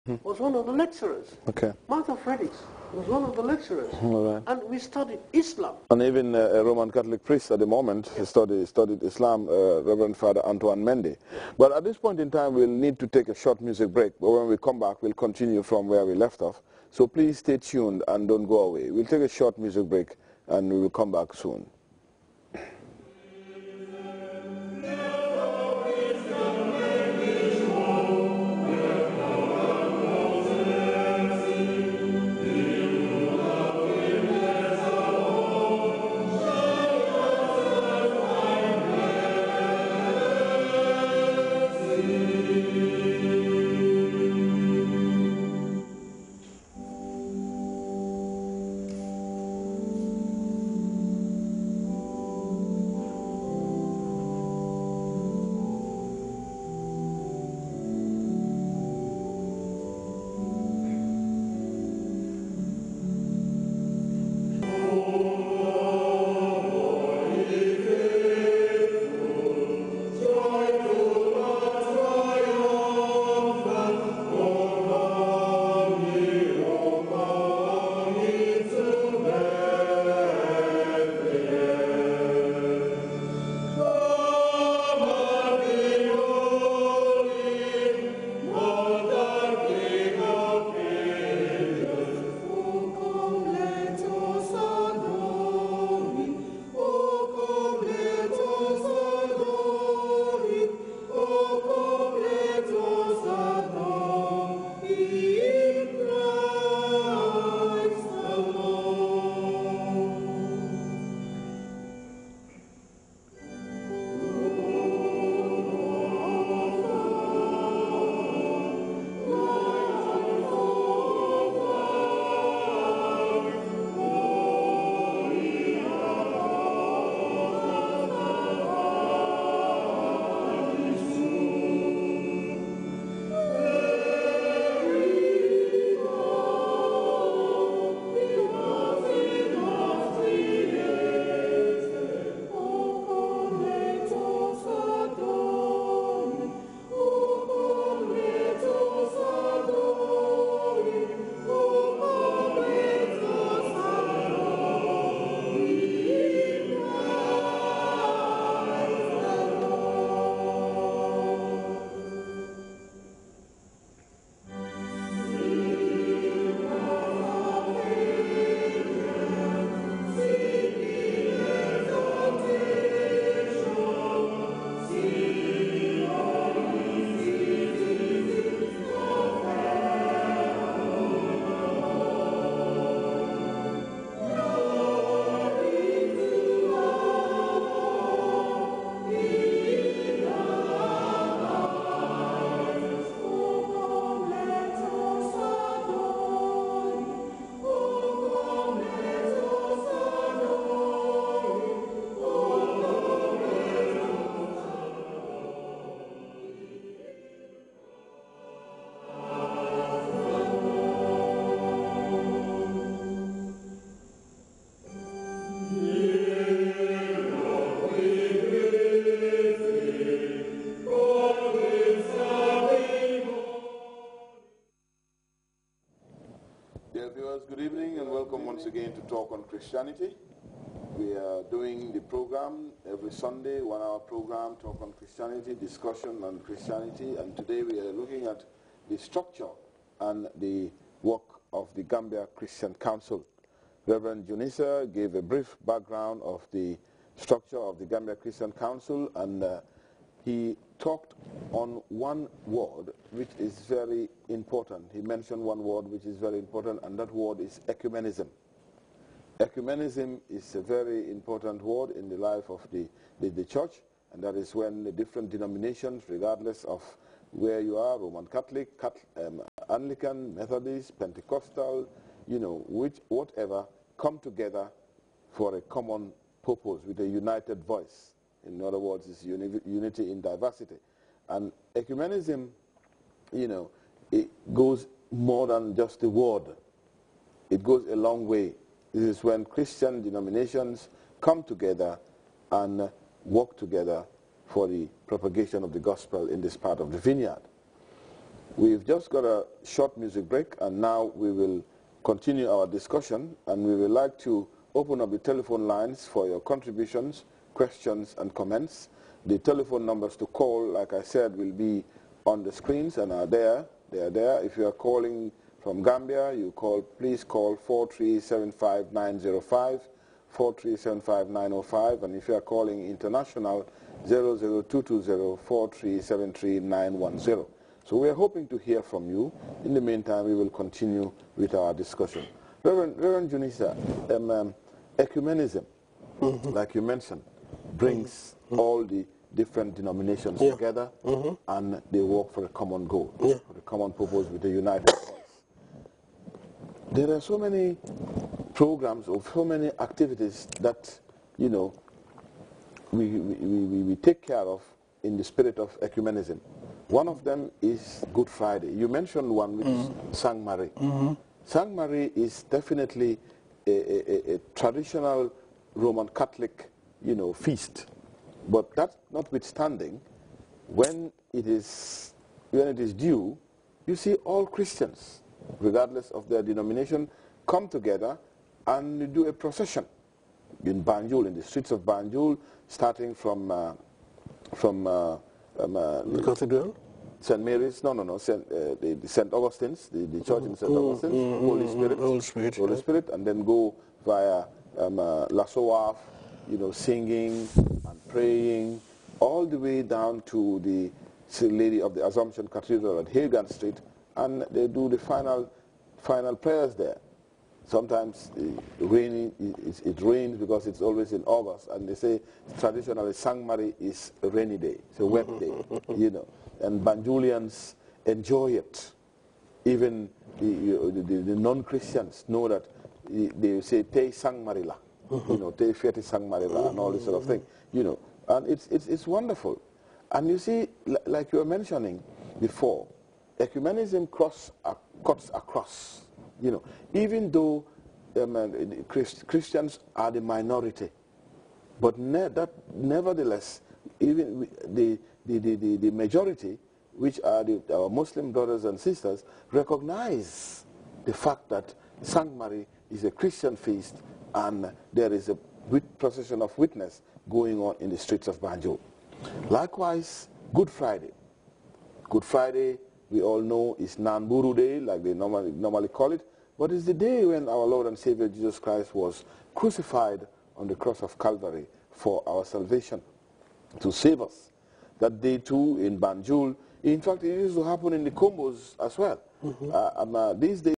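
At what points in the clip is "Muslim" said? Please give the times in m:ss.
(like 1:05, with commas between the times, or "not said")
7:27.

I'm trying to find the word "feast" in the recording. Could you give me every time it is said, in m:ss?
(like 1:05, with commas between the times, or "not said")
6:07, 7:33.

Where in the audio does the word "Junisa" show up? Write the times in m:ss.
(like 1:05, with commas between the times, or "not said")
4:04, 5:33.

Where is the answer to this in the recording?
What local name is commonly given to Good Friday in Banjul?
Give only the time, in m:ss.
7:43.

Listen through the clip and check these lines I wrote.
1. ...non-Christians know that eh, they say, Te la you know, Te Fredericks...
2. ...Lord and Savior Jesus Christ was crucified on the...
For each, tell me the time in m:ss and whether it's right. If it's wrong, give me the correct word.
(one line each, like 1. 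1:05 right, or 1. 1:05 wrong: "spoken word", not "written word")
1. 7:01 wrong: "Fiati", not "Fredericks"
2. 7:47 right.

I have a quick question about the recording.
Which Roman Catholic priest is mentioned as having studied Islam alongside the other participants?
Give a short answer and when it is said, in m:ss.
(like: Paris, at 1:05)
Reverend Father Antoine Mendy, at 0:09.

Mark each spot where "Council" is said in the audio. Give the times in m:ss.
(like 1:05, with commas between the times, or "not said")
4:02, 4:08.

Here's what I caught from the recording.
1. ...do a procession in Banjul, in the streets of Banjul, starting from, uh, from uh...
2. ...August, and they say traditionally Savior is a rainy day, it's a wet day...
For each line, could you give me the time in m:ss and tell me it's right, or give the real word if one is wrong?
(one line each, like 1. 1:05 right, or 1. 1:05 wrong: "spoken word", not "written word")
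1. 6:19 right
2. 6:51 wrong: "Sangmari", not "Savior".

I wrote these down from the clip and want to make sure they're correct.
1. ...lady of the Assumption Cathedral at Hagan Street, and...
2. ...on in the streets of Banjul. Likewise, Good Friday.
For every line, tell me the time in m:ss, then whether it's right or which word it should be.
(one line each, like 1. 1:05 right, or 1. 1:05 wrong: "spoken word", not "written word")
1. 6:41 right
2. 7:37 right.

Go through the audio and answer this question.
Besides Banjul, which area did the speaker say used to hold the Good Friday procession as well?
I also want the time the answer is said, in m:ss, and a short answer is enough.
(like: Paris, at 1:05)
the Kombos, at 7:58.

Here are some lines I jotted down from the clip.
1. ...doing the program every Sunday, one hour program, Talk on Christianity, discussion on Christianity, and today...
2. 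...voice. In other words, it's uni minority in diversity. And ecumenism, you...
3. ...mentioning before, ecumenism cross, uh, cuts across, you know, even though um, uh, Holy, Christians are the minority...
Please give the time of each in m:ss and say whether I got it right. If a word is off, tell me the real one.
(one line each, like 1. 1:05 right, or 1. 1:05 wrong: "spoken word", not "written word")
1. 3:51 right
2. 4:37 wrong: "unity", not "minority"
3. 7:11 wrong: "Christ", not "Holy".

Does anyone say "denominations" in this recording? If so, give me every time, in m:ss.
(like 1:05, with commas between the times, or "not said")
4:25, 4:50, 5:39, 6:16.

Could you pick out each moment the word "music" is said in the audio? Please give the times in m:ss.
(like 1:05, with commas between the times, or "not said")
0:13, 0:19, 4:59.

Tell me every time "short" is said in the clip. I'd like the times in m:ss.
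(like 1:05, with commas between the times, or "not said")
0:13, 0:19, 4:59.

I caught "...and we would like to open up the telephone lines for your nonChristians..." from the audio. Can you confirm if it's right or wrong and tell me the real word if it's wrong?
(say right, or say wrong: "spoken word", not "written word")
wrong: "contributions", not "nonChristians".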